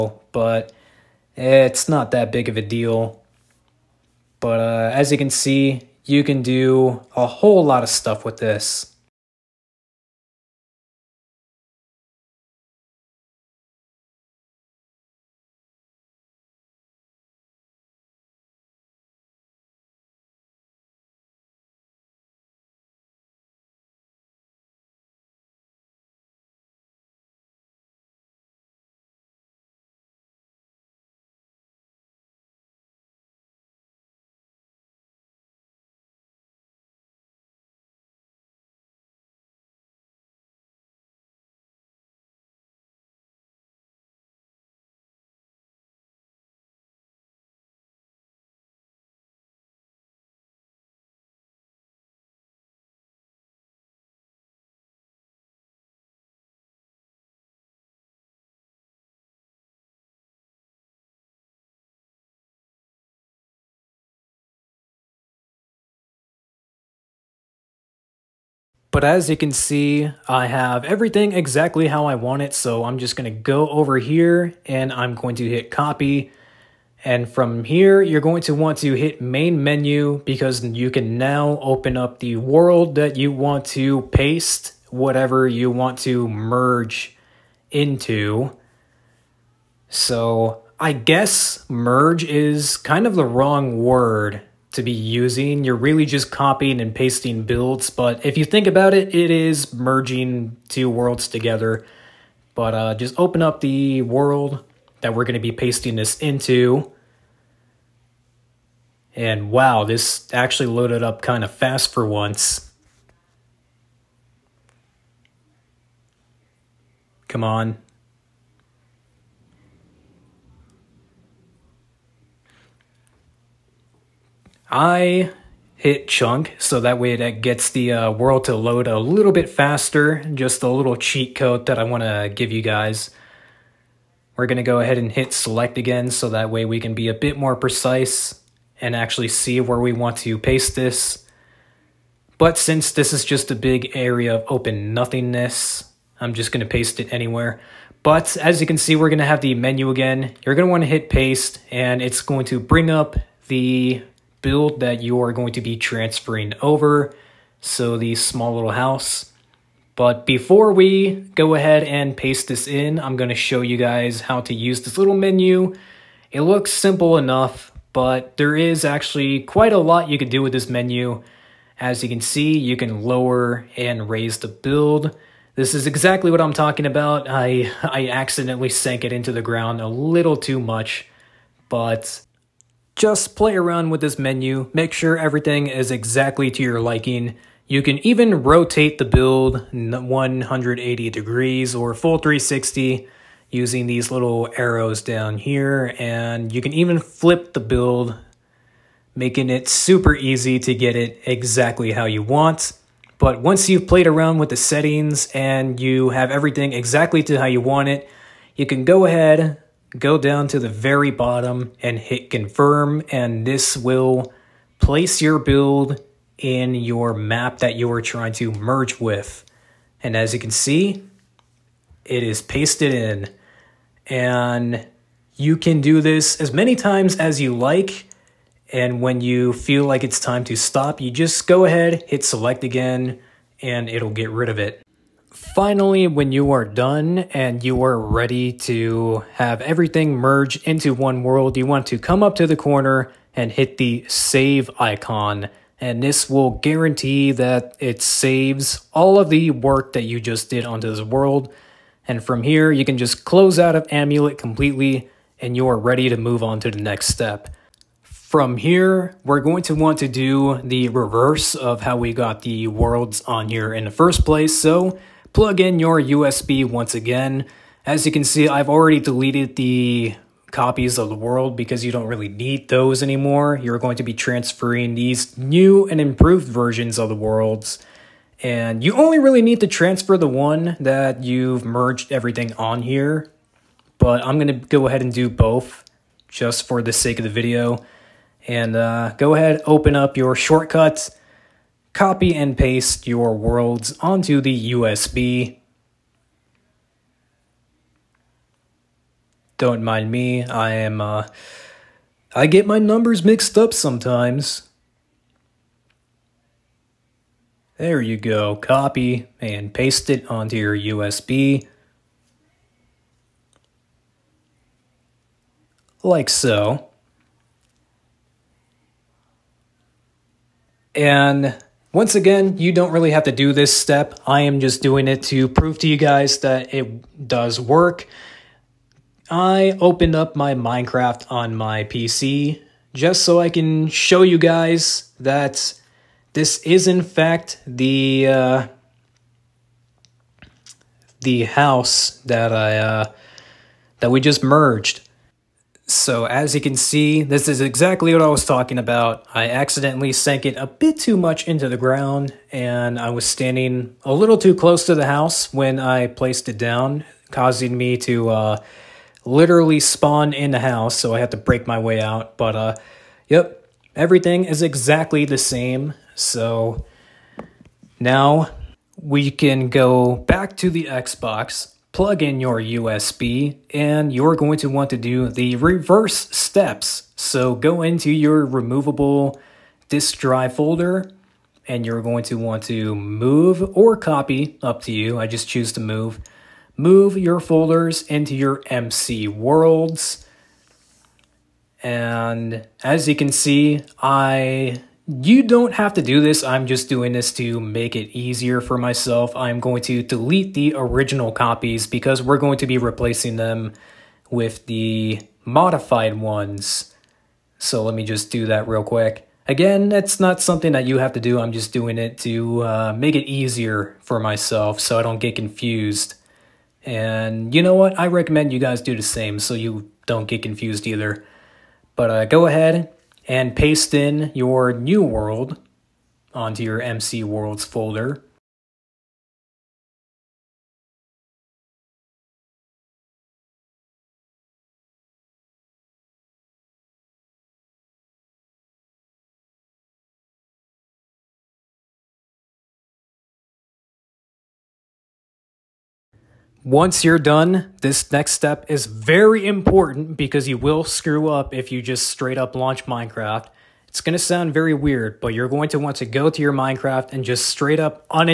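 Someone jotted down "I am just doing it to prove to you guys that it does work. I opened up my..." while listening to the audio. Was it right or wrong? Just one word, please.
right.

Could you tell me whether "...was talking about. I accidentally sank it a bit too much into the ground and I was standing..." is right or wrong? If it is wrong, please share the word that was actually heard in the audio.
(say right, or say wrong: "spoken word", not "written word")
right.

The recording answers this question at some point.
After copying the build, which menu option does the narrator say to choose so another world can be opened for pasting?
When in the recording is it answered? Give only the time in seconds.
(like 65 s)
79 s.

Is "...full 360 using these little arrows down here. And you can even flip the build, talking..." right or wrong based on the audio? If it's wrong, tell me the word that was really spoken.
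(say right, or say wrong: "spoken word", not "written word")
wrong: "making", not "talking".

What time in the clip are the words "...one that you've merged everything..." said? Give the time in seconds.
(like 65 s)
280 s.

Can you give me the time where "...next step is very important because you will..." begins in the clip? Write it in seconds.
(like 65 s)
448 s.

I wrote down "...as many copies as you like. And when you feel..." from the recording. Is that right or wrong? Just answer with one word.
wrong.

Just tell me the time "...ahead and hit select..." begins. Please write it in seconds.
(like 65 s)
134 s.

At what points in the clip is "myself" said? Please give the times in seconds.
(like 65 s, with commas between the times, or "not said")
398 s, 414 s.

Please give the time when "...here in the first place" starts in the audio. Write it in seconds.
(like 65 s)
263 s.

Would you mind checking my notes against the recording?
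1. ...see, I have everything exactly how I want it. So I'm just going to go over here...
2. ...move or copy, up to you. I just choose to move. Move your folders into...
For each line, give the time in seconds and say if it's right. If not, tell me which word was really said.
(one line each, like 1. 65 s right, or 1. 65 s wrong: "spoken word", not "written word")
1. 69 s right
2. 382 s right.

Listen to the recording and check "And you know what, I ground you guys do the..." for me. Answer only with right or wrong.
wrong.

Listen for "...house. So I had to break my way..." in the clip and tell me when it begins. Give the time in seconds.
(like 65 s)
360 s.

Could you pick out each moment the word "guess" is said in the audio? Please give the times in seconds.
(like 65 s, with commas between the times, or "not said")
90 s.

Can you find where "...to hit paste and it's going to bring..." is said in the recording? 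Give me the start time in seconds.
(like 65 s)
150 s.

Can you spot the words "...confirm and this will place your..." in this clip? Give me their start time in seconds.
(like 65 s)
212 s.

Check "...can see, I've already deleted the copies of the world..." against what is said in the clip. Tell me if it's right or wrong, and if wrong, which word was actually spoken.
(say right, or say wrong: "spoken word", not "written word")
right.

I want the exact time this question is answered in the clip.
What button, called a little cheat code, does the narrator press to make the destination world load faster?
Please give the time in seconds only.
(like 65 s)
126 s.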